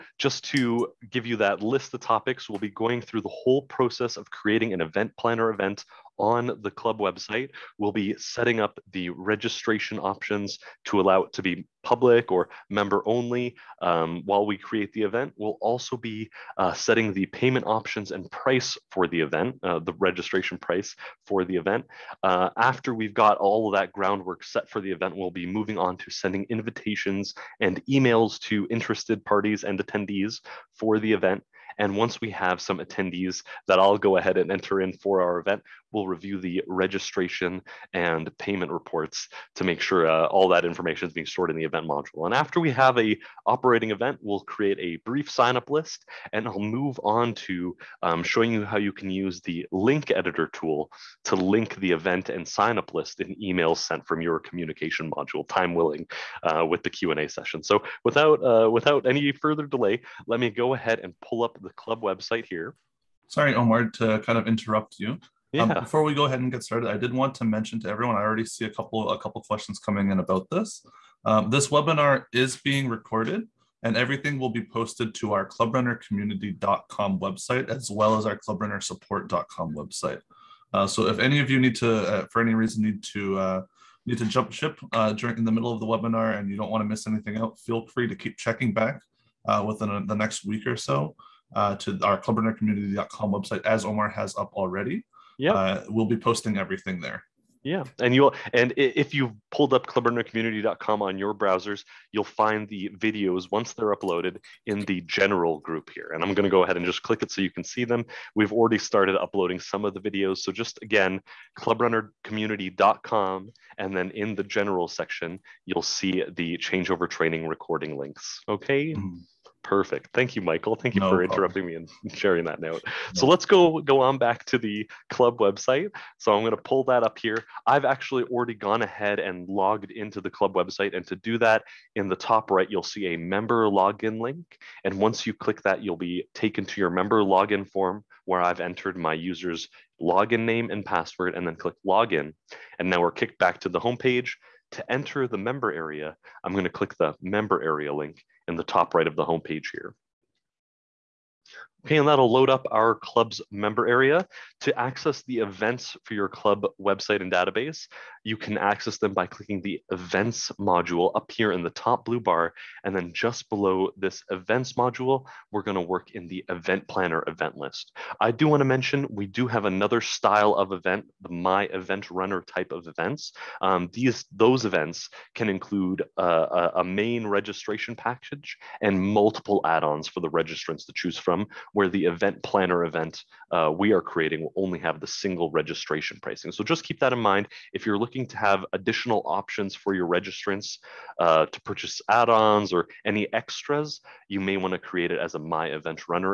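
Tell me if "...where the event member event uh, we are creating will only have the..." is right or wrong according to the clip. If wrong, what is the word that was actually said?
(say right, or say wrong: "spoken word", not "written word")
wrong: "planner", not "member".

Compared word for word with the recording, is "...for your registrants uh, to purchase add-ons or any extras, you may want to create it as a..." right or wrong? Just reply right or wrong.
right.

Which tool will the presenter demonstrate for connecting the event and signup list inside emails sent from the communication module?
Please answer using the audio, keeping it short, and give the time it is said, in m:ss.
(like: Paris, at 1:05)
link editor tool, at 0:49.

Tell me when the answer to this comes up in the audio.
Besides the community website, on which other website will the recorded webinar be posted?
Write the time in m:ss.
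1:18.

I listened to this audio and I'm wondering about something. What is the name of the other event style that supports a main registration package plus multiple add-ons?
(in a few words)
My Event Runner.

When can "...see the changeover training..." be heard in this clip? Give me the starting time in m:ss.
1:55.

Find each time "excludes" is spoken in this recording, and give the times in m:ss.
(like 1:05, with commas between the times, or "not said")
not said.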